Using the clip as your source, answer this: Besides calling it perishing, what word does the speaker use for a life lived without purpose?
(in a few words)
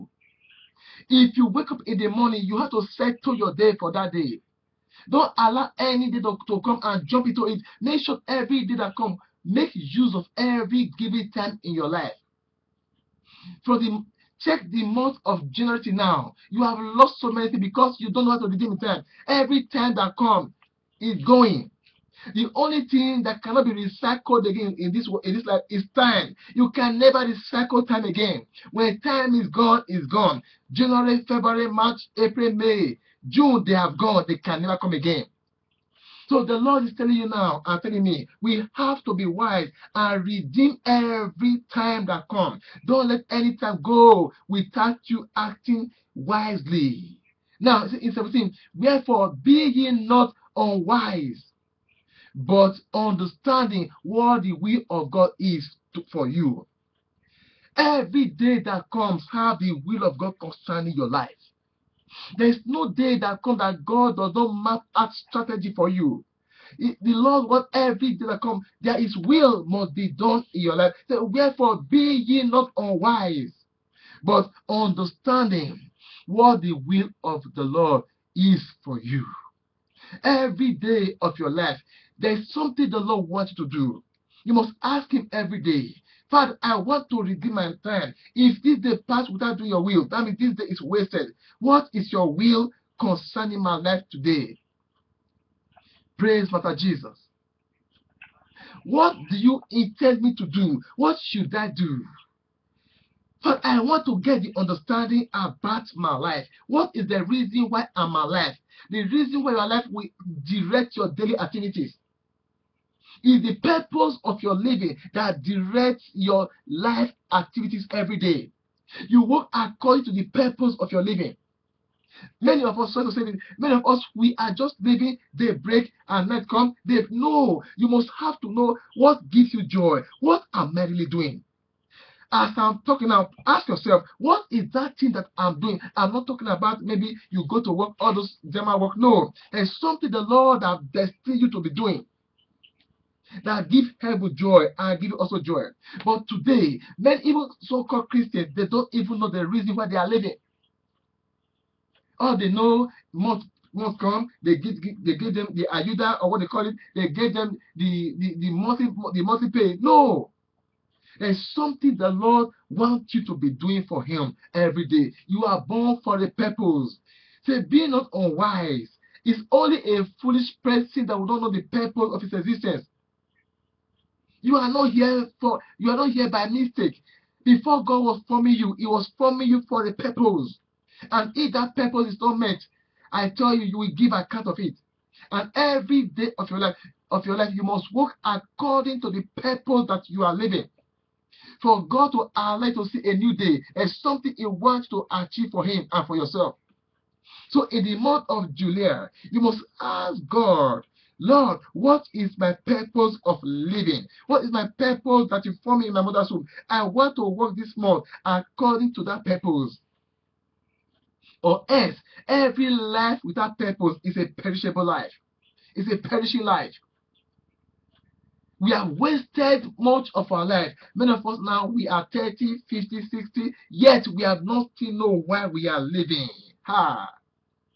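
Perishable.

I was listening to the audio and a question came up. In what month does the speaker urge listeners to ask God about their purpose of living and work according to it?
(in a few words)
July.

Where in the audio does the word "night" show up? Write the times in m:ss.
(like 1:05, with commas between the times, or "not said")
2:06.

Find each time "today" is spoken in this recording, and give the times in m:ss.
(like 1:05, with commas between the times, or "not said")
1:34, 2:26.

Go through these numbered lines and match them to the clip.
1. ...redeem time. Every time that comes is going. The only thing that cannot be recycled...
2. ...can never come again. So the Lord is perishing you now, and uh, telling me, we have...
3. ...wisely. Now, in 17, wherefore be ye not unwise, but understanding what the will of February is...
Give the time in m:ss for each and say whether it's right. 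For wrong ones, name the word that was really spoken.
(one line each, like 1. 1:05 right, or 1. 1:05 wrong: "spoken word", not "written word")
1. 0:18 right
2. 0:34 wrong: "telling", not "perishing"
3. 0:46 wrong: "God", not "February".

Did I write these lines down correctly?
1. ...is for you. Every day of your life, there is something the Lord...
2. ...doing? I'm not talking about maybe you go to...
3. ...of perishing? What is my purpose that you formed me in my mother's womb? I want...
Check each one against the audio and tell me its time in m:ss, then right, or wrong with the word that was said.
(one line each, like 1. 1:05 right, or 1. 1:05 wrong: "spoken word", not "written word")
1. 1:18 right
2. 2:15 right
3. 3:23 wrong: "living", not "perishing".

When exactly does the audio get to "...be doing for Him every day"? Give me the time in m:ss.
2:43.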